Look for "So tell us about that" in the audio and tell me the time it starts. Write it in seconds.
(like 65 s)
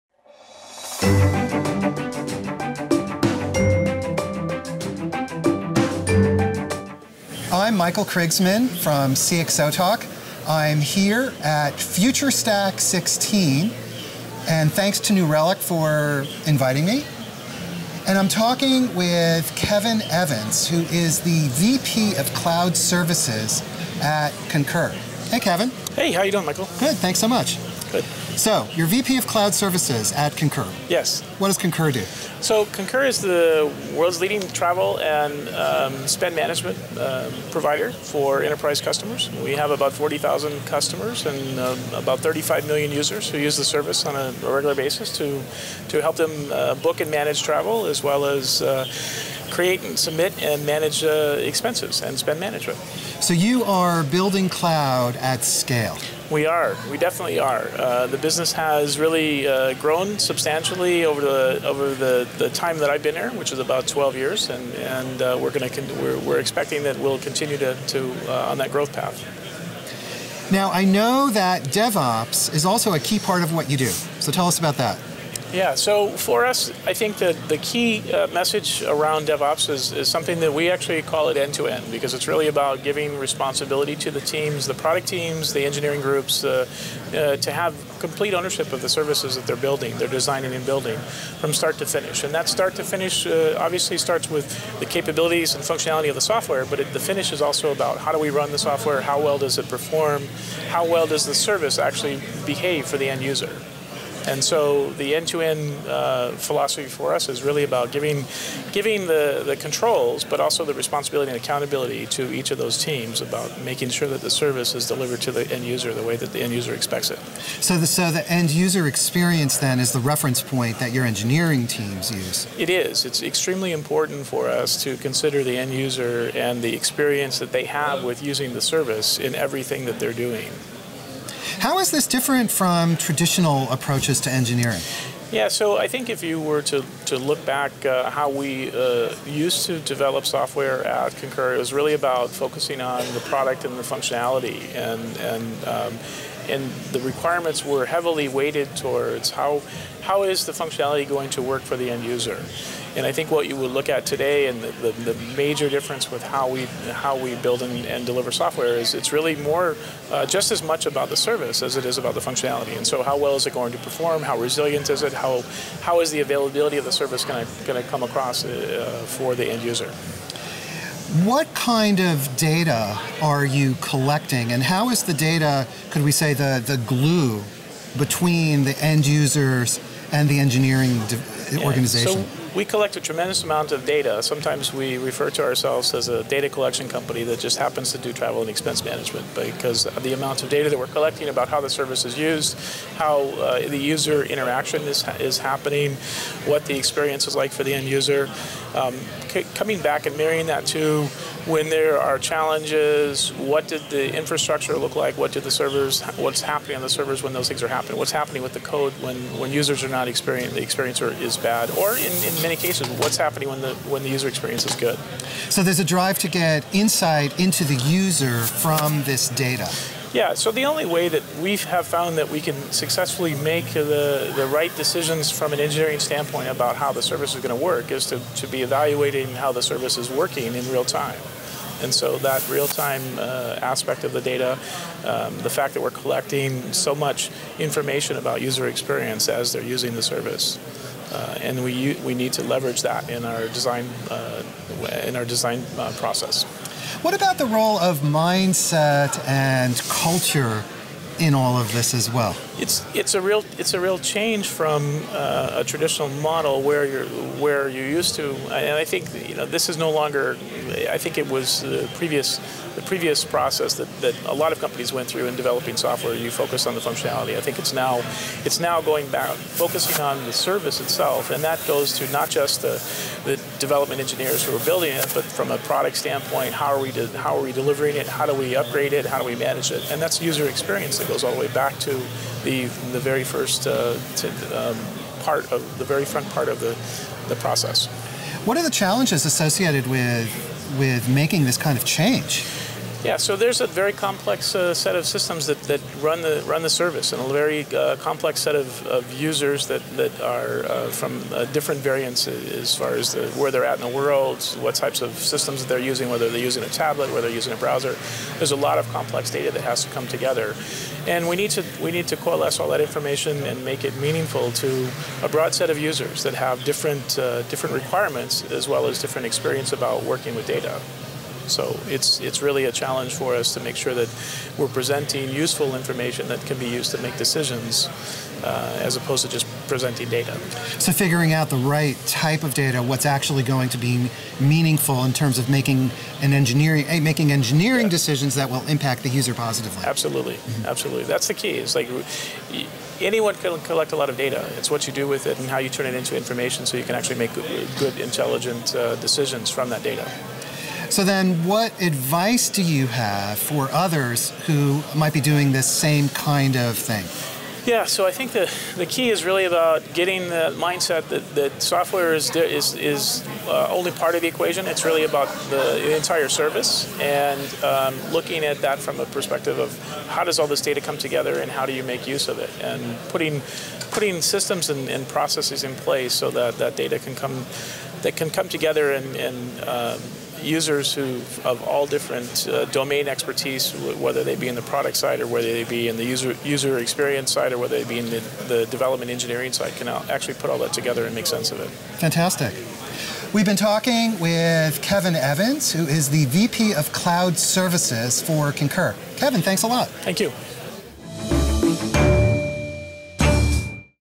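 74 s.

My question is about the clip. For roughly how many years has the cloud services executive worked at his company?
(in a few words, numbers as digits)
12 years.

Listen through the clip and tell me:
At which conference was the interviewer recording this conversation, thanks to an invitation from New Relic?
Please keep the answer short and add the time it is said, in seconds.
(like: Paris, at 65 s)
Future Stack 16, at 11 s.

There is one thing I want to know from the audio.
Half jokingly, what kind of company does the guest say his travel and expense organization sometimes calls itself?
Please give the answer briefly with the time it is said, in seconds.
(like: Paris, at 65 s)
data collection company, at 186 s.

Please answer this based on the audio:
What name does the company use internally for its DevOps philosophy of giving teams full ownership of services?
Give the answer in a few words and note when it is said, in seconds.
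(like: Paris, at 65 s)
end to end, at 81 s.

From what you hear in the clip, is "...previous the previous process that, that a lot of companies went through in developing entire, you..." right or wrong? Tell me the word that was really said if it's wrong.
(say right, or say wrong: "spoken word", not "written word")
wrong: "software", not "entire".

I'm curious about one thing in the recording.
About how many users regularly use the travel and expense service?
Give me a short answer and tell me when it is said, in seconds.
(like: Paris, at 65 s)
35 million, at 42 s.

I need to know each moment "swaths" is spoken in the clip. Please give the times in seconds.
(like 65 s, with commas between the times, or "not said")
not said.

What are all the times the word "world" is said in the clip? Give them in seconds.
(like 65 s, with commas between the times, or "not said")
33 s, 303 s.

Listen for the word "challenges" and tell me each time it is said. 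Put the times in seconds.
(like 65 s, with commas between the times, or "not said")
202 s, 288 s, 322 s.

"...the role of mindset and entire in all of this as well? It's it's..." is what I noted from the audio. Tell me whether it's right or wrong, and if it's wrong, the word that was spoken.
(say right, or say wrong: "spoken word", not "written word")
wrong: "culture", not "entire".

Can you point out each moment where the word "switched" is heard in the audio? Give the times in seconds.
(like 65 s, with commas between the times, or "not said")
not said.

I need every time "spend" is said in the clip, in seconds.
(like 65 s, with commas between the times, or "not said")
36 s, 52 s.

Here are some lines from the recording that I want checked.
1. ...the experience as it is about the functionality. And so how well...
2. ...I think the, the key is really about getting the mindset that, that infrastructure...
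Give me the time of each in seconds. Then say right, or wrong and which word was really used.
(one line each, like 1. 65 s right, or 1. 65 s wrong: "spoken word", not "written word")
1. 161 s wrong: "service", not "experience"
2. 358 s wrong: "software", not "infrastructure".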